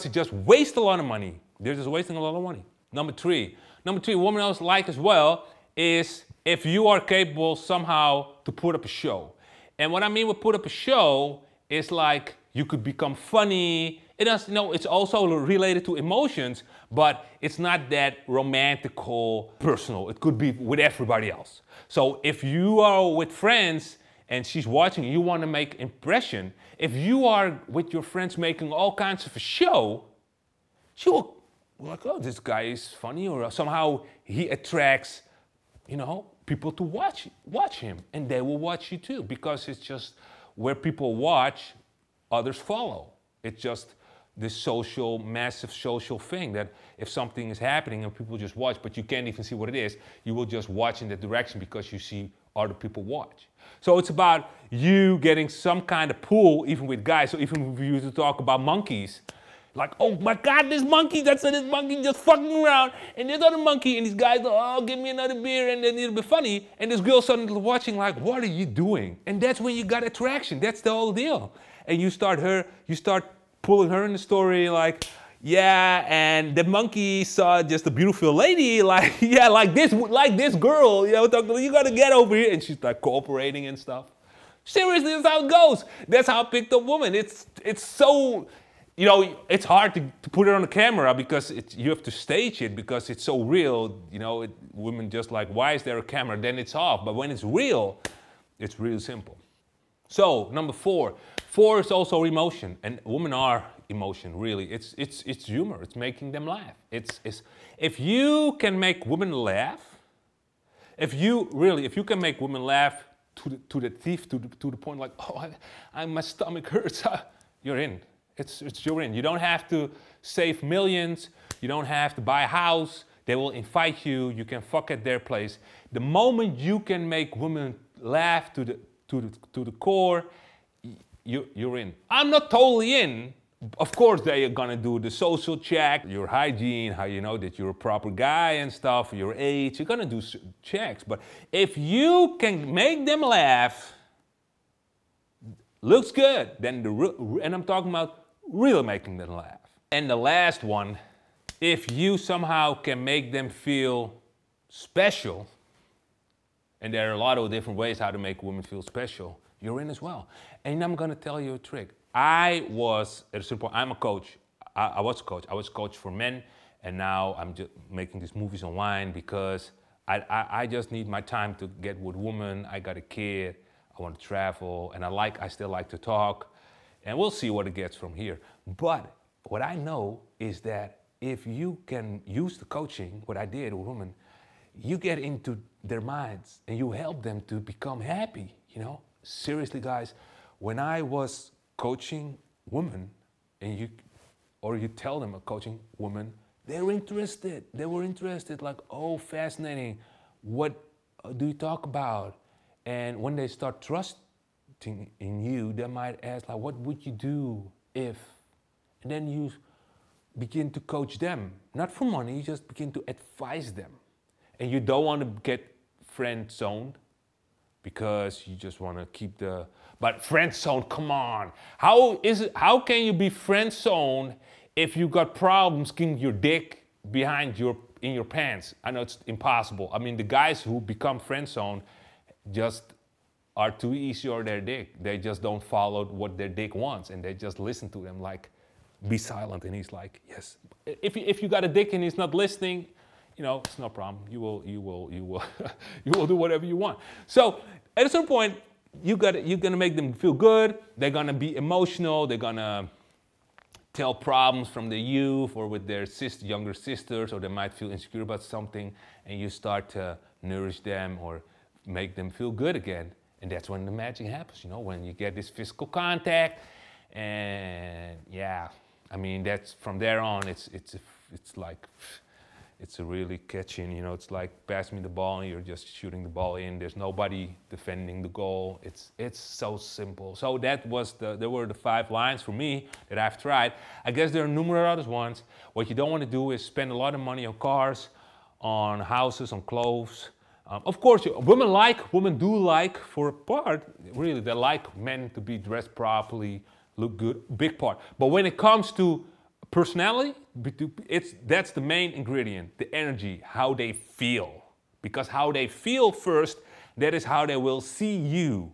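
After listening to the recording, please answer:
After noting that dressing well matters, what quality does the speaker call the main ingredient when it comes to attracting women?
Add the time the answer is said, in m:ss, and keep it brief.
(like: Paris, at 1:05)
personality, at 4:59.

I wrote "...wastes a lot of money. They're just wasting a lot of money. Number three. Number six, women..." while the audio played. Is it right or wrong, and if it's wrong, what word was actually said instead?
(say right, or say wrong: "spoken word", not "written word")
wrong: "three", not "six".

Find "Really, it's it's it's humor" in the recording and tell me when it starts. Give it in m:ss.
1:44.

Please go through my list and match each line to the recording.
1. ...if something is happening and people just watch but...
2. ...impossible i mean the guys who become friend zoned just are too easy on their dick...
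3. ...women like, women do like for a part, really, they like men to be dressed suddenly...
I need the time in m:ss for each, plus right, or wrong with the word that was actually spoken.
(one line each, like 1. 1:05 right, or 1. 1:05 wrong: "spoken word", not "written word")
1. 0:46 right
2. 3:49 right
3. 4:51 wrong: "properly", not "suddenly".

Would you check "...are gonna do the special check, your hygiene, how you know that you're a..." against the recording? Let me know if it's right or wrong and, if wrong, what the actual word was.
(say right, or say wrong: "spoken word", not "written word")
wrong: "social", not "special".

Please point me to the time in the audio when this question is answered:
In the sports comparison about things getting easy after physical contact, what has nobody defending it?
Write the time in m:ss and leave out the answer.
4:38.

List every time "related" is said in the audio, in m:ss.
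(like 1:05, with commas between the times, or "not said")
0:15.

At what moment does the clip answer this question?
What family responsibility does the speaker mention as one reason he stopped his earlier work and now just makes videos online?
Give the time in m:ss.
2:52.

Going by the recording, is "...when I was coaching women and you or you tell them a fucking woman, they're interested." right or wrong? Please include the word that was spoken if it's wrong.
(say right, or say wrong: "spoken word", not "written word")
wrong: "coaching", not "fucking".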